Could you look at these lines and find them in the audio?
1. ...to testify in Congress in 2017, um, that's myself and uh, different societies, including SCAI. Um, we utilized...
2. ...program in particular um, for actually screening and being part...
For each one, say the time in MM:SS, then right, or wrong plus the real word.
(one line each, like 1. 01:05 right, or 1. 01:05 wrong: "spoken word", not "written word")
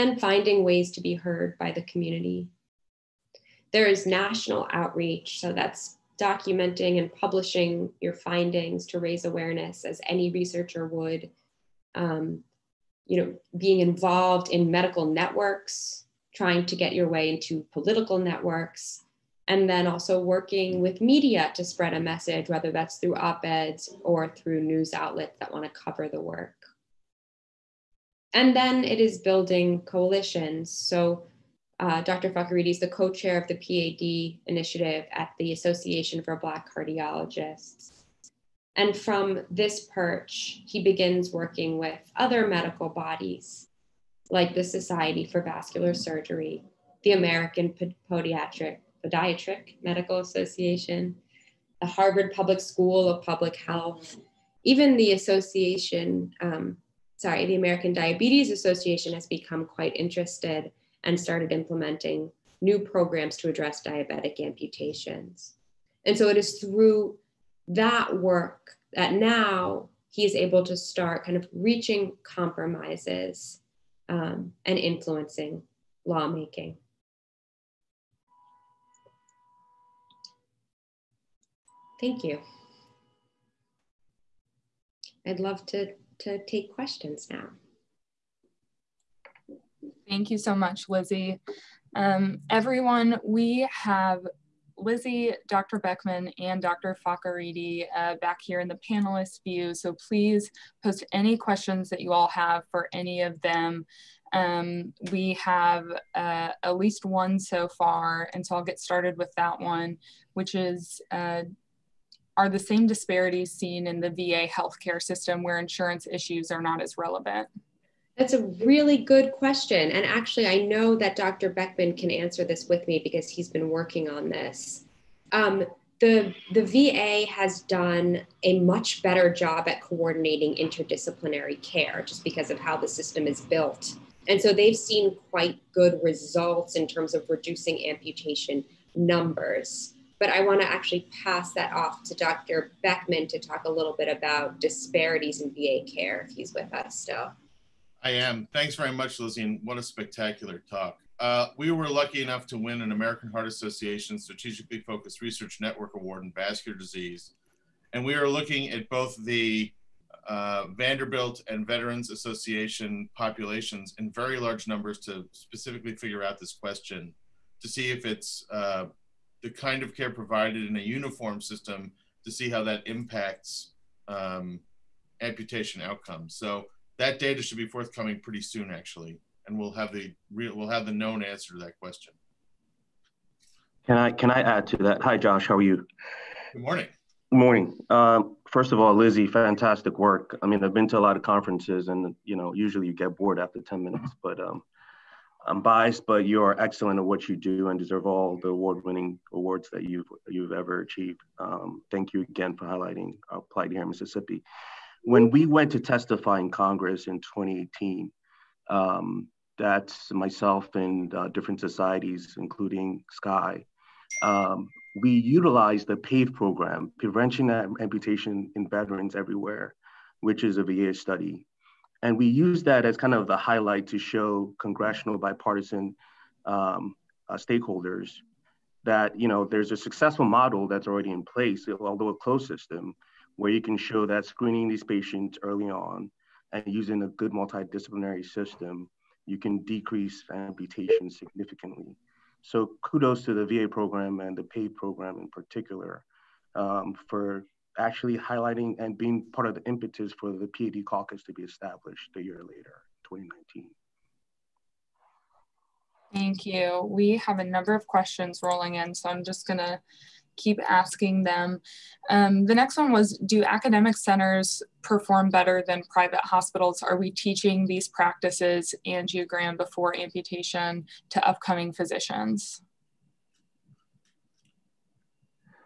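1. 03:25 wrong: "2018", not "2017"
2. 04:04 wrong: "highlighting", not "screening".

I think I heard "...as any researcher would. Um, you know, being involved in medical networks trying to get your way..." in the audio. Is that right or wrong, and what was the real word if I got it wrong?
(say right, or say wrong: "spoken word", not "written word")
right.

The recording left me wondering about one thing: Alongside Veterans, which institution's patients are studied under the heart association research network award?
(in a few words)
Vanderbilt.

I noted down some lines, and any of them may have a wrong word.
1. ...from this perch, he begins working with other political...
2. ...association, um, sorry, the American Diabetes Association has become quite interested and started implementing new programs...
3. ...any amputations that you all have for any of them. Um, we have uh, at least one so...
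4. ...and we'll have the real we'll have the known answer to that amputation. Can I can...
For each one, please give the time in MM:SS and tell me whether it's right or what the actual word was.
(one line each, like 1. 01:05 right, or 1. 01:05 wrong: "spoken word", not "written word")
1. 00:38 wrong: "medical", not "political"
2. 00:55 right
3. 01:41 wrong: "questions", not "amputations"
4. 02:59 wrong: "question", not "amputation".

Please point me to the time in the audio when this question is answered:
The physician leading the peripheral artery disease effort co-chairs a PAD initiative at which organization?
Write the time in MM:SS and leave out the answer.
00:35.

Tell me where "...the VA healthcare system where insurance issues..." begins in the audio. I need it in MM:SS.
01:54.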